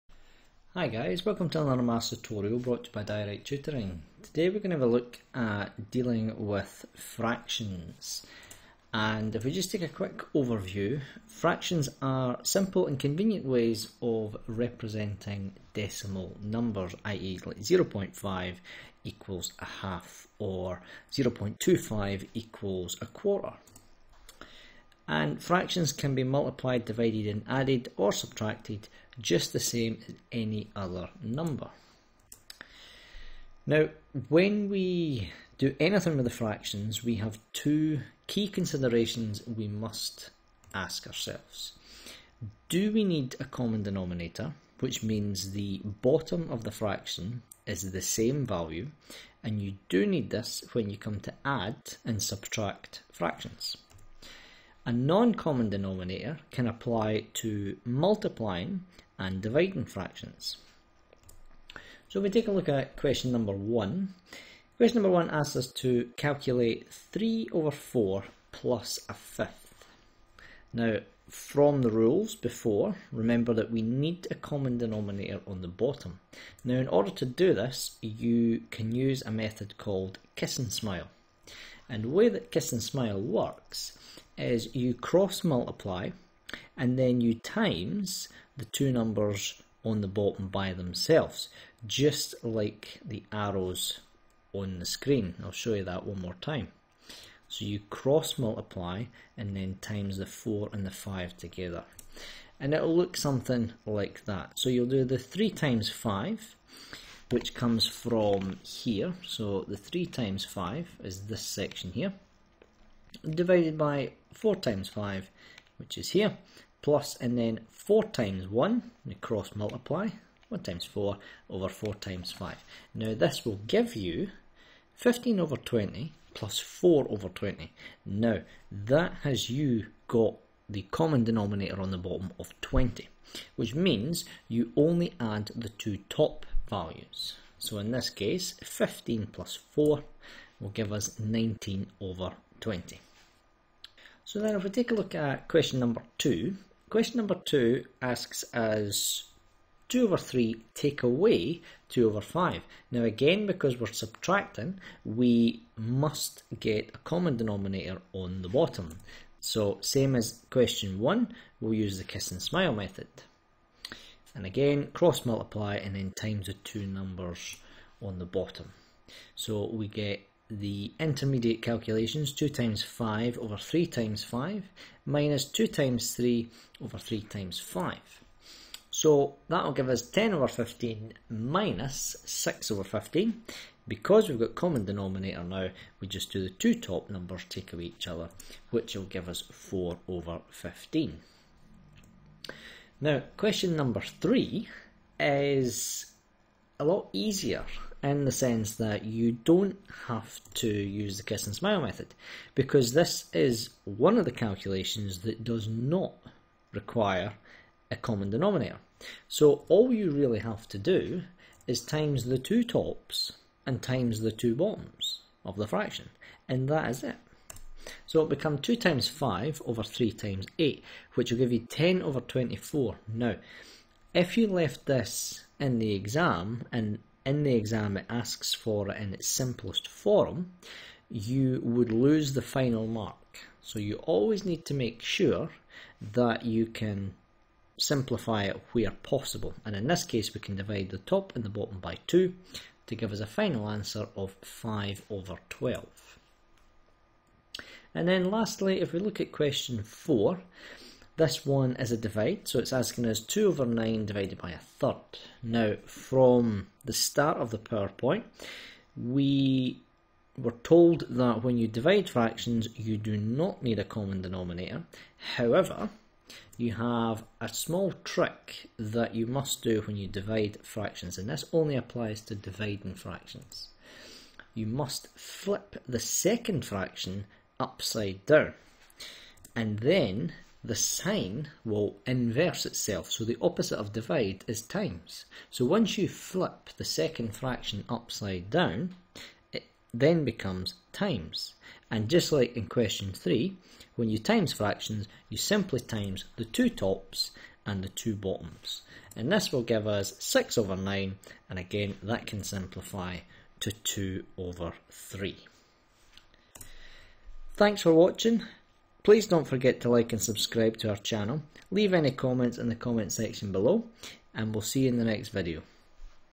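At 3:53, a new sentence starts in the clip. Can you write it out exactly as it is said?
So you always need to make sure that you can simplify it where possible.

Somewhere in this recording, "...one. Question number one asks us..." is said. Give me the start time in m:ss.
1:03.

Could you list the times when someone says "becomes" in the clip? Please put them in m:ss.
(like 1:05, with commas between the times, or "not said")
3:38, 4:50.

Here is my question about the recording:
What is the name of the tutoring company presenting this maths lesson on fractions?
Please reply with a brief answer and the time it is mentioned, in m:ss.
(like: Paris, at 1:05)
Direct Tutoring, at 0:03.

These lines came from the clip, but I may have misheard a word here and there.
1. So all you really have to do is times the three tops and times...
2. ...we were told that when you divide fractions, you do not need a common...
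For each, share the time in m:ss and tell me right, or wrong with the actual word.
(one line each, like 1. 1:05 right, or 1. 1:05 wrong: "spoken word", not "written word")
1. 3:29 wrong: "two", not "three"
2. 4:18 right.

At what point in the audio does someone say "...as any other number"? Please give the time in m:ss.
0:30.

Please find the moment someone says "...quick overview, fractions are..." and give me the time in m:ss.
0:09.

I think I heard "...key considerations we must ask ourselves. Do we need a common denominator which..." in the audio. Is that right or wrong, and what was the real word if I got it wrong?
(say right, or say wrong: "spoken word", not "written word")
right.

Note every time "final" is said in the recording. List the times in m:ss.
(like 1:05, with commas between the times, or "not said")
3:52, 4:03.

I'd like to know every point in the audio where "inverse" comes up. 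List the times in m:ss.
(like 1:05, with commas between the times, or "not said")
4:42.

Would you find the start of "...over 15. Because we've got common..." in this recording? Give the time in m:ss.
3:02.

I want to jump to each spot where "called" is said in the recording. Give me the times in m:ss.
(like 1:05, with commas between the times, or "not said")
1:19.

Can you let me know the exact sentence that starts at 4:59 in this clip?
And this will give us 6 over 9, and again that can simplify to 2 over 3.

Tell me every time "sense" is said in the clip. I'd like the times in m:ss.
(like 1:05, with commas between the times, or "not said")
3:18.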